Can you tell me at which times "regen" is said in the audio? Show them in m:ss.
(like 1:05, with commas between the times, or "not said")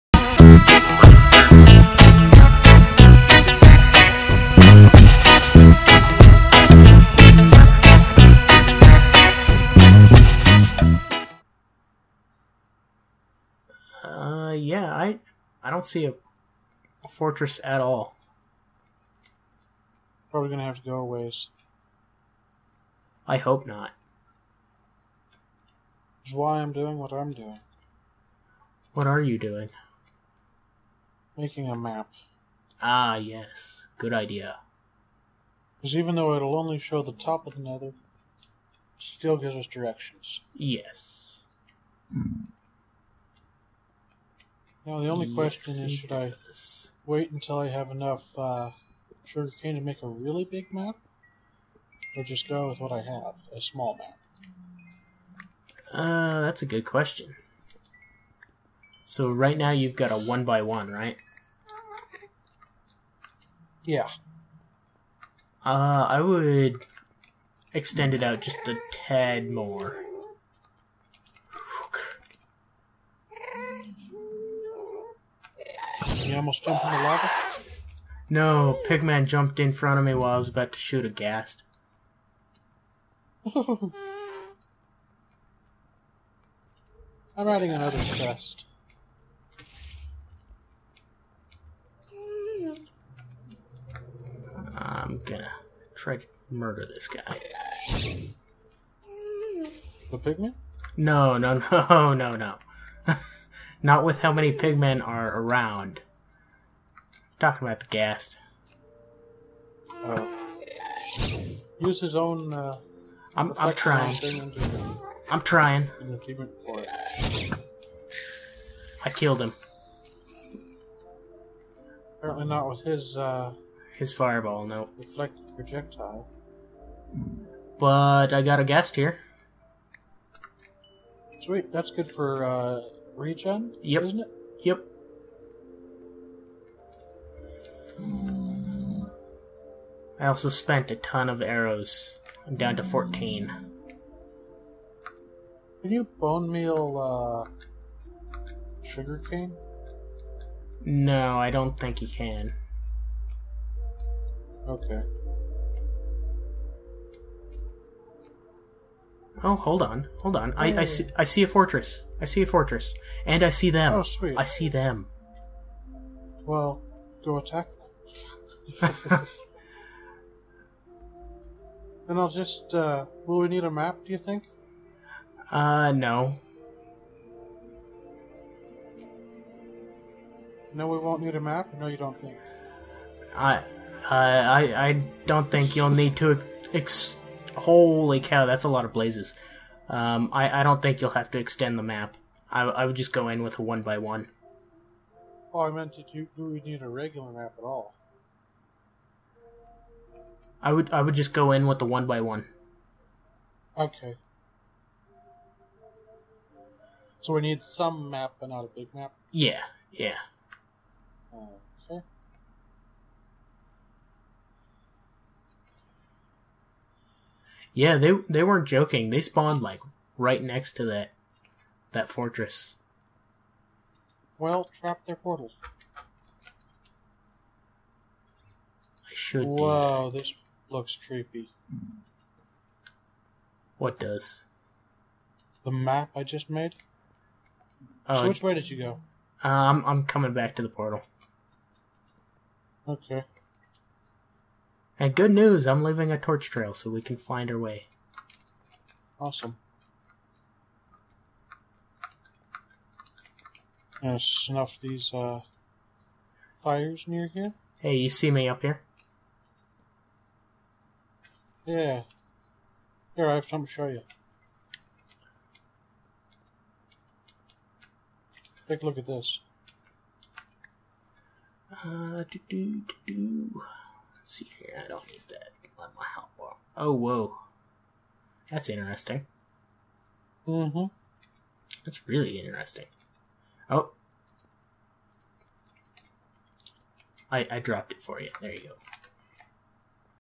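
2:13.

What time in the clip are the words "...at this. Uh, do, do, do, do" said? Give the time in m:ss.
4:28.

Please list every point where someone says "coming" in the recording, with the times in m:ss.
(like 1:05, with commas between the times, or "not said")
4:00.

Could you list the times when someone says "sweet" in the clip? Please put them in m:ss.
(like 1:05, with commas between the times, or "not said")
2:11, 2:44.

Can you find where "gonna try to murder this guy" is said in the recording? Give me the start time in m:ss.
1:35.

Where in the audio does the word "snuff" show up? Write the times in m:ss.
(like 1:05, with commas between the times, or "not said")
4:14.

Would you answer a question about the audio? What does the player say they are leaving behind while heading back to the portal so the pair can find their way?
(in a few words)
torch trail.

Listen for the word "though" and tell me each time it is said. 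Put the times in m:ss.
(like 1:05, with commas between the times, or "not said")
0:36.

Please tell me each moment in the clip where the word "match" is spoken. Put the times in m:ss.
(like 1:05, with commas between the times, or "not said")
not said.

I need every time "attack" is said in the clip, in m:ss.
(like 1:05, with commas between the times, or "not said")
2:47.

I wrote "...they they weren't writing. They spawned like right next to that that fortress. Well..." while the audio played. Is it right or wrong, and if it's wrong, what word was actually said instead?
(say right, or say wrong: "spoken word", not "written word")
wrong: "joking", not "writing".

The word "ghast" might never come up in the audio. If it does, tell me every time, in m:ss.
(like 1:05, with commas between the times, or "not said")
1:21, 1:47, 2:08.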